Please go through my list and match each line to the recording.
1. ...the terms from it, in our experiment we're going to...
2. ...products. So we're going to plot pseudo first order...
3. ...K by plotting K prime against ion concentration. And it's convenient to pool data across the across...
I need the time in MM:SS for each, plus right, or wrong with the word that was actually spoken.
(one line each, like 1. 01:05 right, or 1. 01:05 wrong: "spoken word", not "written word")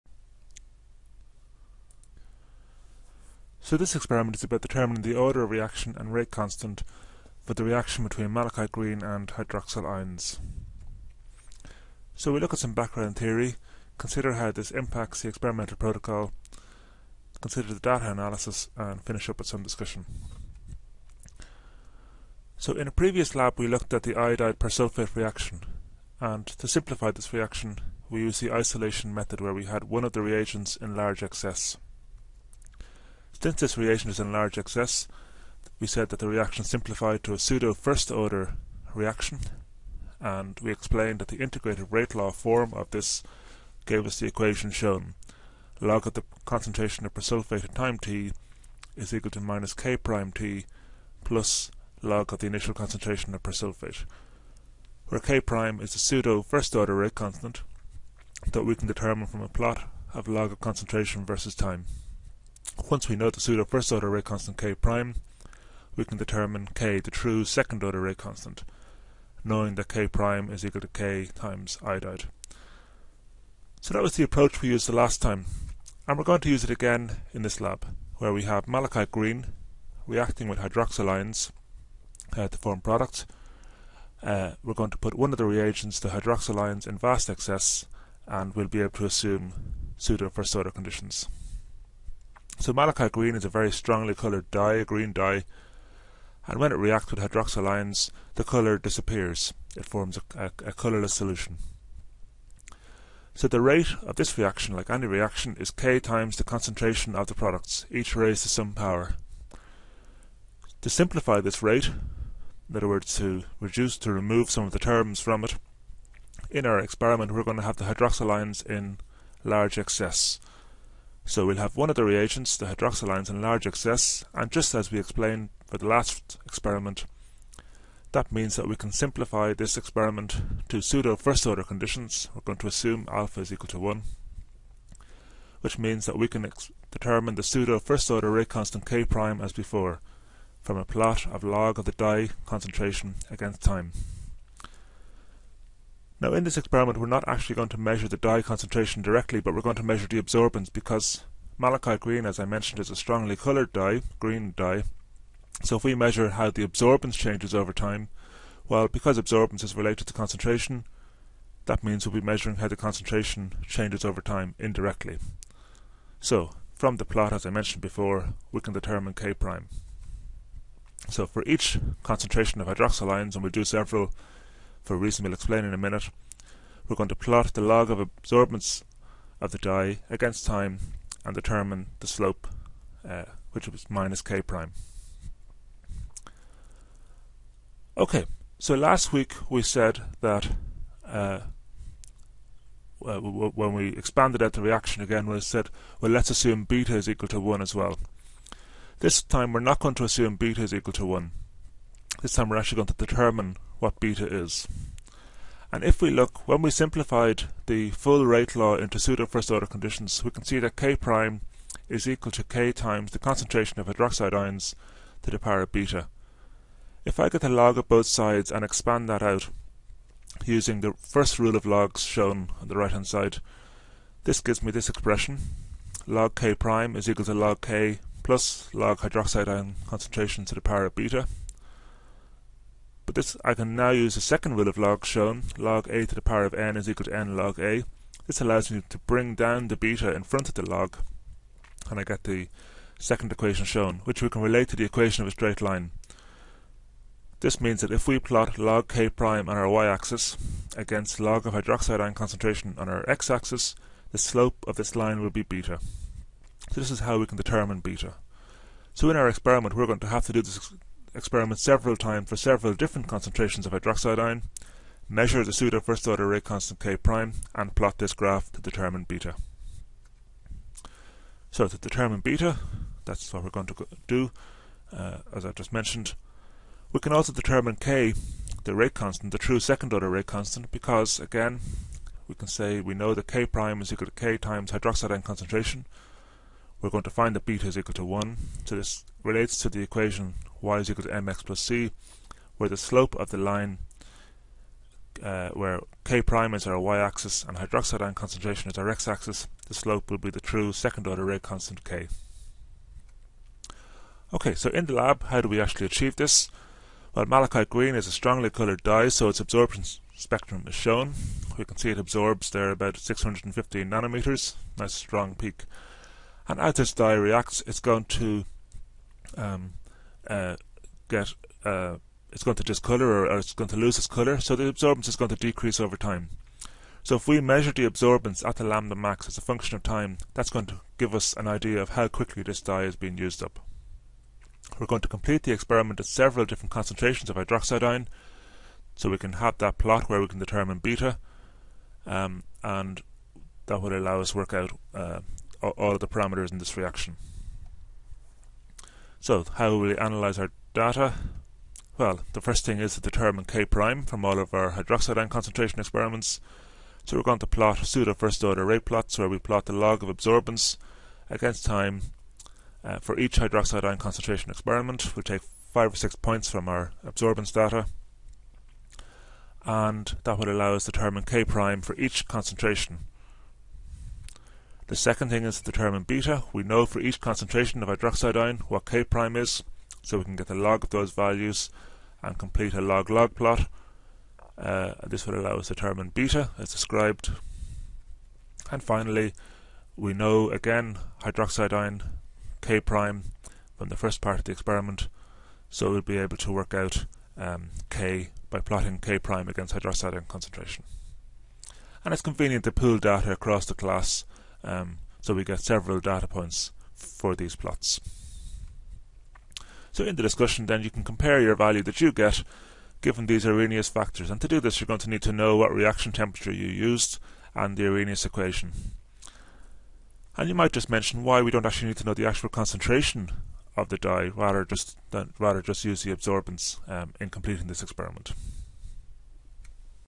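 1. 01:54 right
2. 05:55 wrong: "experiments", not "products"
3. 06:37 wrong: "class", not "across".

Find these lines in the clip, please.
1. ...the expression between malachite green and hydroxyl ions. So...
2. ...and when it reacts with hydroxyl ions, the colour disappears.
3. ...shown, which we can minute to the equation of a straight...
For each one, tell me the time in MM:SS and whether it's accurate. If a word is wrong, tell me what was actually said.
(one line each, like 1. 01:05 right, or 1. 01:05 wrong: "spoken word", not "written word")
1. 00:07 wrong: "reaction", not "expression"
2. 01:36 right
3. 04:03 wrong: "relate", not "minute".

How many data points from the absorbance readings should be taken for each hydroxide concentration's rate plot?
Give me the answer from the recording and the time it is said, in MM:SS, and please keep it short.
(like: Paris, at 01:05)
5 or 6, at 06:05.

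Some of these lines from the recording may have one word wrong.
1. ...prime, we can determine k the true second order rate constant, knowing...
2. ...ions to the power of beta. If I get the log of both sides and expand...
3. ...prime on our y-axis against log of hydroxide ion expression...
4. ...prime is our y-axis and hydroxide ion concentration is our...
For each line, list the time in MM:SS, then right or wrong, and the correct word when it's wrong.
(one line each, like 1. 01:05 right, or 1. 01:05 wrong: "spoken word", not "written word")
1. 01:04 right
2. 03:34 right
3. 04:09 wrong: "concentration", not "expression"
4. 04:56 right.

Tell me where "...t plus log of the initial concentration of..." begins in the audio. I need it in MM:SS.
00:50.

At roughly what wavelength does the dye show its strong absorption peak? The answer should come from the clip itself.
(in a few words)
615 nanometers.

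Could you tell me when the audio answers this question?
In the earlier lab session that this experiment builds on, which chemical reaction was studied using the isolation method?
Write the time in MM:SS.
00:24.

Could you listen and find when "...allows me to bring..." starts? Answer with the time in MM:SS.
03:58.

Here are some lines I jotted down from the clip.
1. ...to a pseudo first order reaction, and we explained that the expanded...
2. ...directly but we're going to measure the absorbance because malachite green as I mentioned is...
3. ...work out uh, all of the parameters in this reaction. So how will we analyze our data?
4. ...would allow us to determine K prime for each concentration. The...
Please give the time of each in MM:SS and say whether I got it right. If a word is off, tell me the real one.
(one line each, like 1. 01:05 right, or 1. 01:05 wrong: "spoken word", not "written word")
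1. 00:37 wrong: "integrated", not "expanded"
2. 02:29 right
3. 05:44 right
4. 06:10 right.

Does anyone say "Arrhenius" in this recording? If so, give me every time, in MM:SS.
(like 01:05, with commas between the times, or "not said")
06:53, 06:57.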